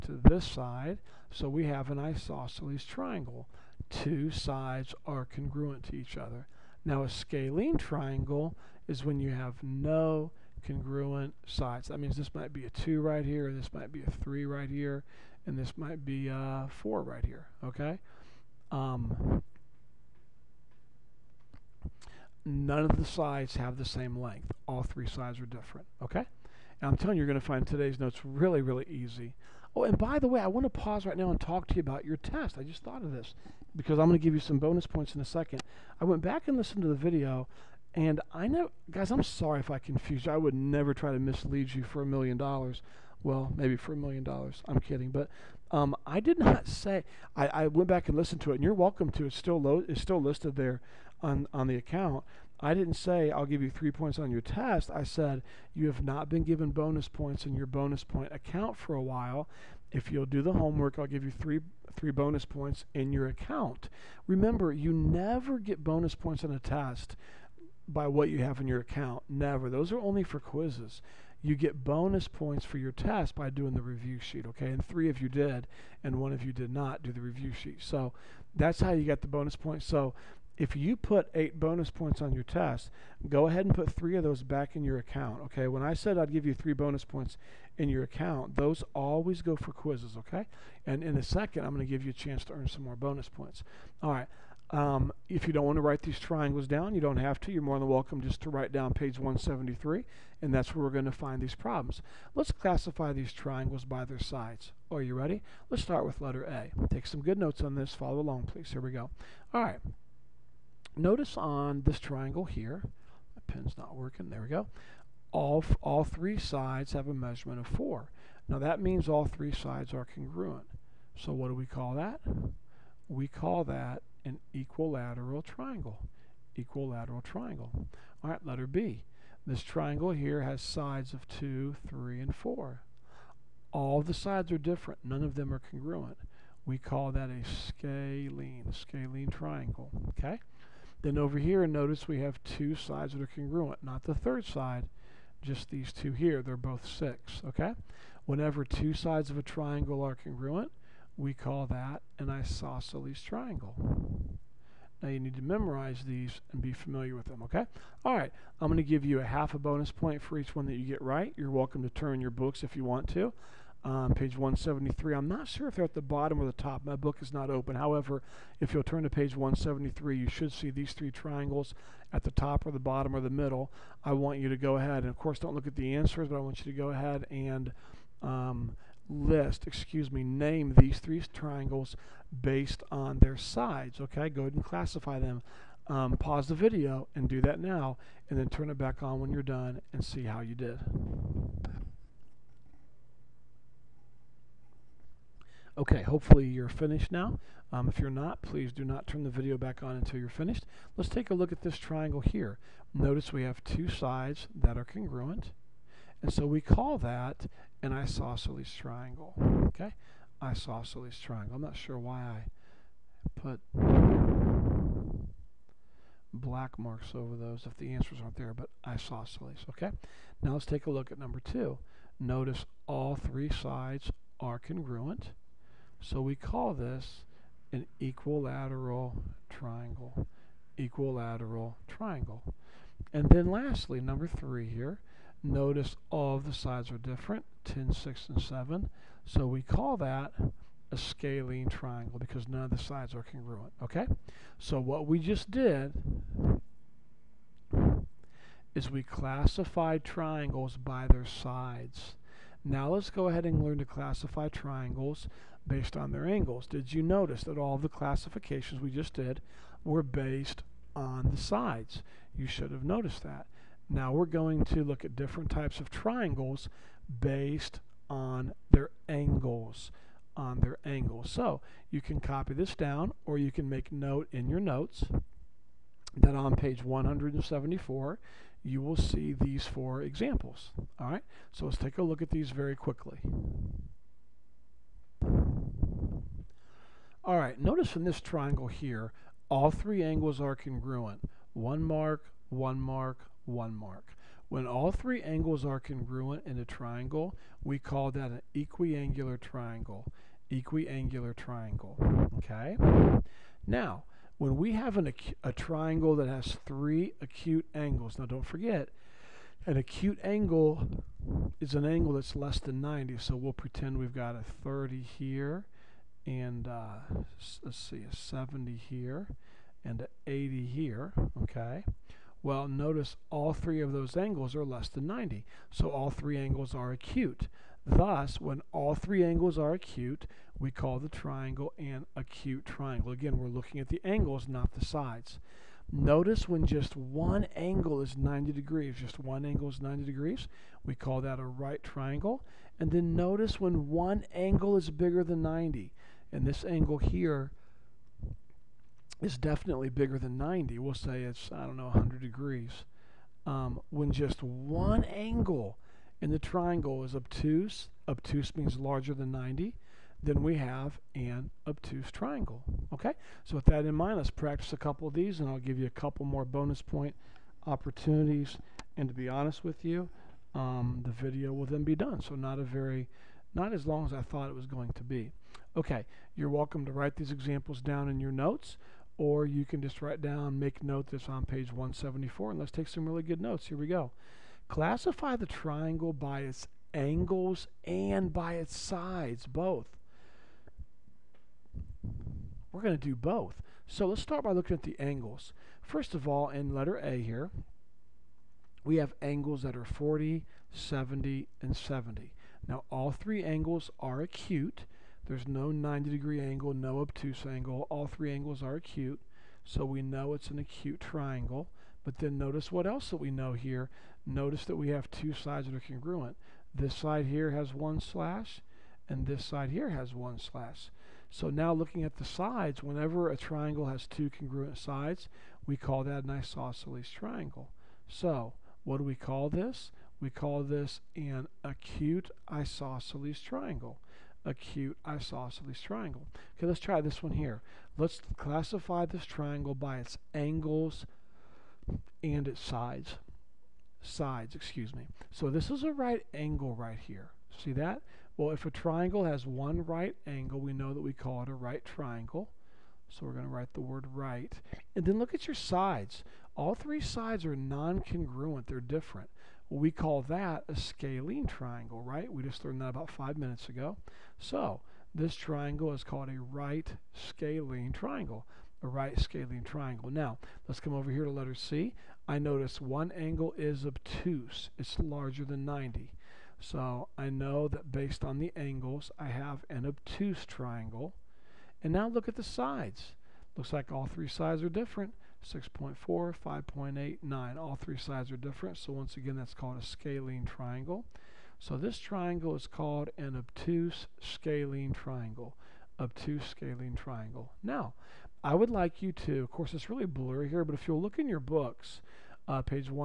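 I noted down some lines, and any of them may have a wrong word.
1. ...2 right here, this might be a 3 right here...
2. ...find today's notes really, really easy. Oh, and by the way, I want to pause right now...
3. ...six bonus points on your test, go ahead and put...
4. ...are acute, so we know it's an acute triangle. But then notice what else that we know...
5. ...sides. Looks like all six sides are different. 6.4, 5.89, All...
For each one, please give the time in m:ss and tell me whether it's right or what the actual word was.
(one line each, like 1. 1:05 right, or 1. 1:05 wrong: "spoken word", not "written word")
1. 0:12 right
2. 0:27 right
3. 1:21 wrong: "eight", not "six"
4. 6:48 right
5. 8:02 wrong: "three", not "six".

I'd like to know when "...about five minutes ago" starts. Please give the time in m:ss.
7:42.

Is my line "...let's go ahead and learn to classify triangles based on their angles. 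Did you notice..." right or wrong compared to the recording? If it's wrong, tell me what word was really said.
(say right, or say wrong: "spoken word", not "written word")
right.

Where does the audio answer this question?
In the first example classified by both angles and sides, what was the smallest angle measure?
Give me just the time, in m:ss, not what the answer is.
6:39.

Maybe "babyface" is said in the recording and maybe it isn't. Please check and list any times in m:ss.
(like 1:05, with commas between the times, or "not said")
not said.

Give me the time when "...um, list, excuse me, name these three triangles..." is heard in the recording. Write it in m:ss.
2:58.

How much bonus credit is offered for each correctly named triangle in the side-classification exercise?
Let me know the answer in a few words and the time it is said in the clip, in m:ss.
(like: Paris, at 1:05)
half a bonus point, at 2:39.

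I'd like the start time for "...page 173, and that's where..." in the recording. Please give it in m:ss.
1:38.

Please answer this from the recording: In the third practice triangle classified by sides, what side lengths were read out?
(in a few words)
10, 6, and 7.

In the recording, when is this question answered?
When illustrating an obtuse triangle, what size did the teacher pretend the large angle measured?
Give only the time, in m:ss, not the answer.
5:51.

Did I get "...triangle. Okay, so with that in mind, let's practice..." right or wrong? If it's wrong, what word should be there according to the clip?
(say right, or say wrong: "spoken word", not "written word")
right.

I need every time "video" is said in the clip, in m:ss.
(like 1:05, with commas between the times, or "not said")
0:36, 3:06, 3:19, 6:11.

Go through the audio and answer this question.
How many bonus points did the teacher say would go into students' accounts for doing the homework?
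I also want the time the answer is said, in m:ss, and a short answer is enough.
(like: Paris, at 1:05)
3, at 1:01.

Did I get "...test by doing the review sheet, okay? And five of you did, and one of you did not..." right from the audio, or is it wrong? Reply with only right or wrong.
wrong.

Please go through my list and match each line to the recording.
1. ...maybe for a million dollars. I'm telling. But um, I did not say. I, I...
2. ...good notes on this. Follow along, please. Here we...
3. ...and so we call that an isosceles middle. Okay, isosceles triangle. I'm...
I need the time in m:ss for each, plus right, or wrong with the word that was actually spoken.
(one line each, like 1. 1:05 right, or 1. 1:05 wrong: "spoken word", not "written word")
1. 0:43 wrong: "kidding", not "telling"
2. 1:47 right
3. 3:26 wrong: "triangle", not "middle".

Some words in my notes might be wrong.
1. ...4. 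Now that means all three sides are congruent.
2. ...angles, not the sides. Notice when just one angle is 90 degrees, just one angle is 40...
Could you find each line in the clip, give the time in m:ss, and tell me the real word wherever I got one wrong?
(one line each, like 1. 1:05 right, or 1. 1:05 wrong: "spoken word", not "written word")
1. 1:57 right
2. 5:34 wrong: "90", not "40".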